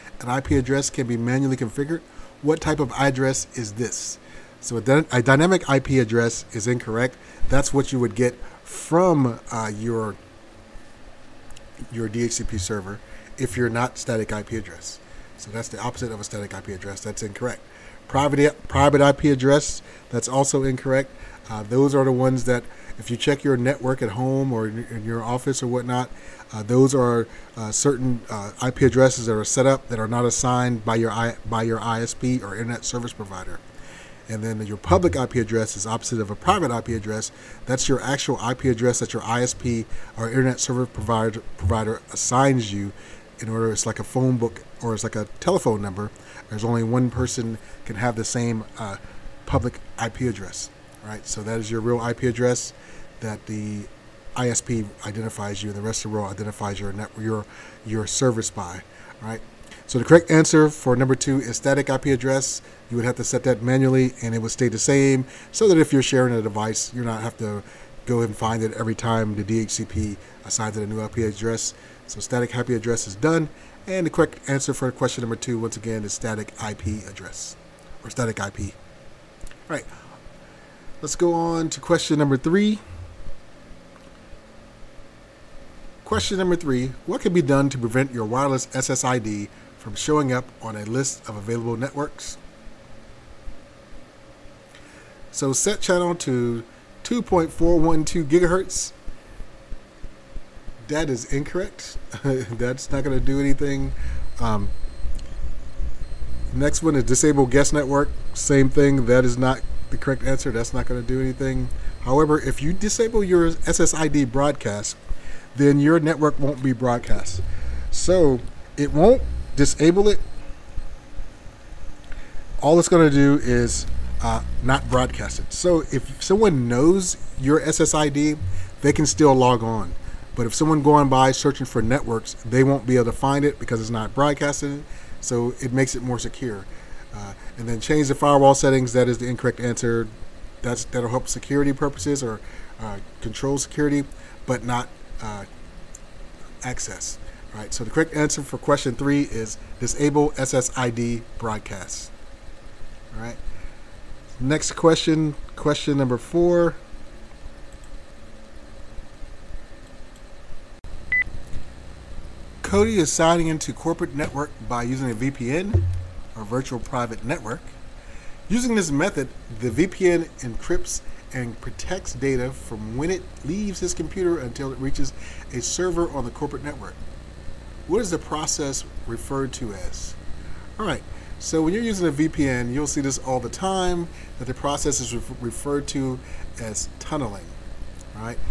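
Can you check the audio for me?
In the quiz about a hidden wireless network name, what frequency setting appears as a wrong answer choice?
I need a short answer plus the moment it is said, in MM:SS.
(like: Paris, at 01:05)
2.412 gigahertz, at 01:37.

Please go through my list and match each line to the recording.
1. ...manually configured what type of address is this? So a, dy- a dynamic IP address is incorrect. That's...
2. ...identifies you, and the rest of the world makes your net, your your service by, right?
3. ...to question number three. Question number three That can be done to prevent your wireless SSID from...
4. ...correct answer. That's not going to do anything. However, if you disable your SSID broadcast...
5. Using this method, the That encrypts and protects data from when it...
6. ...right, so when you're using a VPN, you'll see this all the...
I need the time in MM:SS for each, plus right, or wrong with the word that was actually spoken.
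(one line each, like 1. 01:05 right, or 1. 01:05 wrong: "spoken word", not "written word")
1. 00:01 right
2. 00:55 wrong: "identifies", not "makes"
3. 01:21 wrong: "What", not "That"
4. 01:50 right
5. 02:48 wrong: "VPN", not "That"
6. 03:00 right.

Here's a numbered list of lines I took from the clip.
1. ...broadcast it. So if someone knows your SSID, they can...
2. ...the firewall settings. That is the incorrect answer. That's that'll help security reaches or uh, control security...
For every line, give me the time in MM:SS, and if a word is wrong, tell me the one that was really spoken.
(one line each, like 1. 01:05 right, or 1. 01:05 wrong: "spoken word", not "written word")
1. 02:04 right
2. 02:18 wrong: "purposes", not "reaches".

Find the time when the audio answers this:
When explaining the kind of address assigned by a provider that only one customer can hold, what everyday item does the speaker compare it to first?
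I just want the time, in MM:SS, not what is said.
00:44.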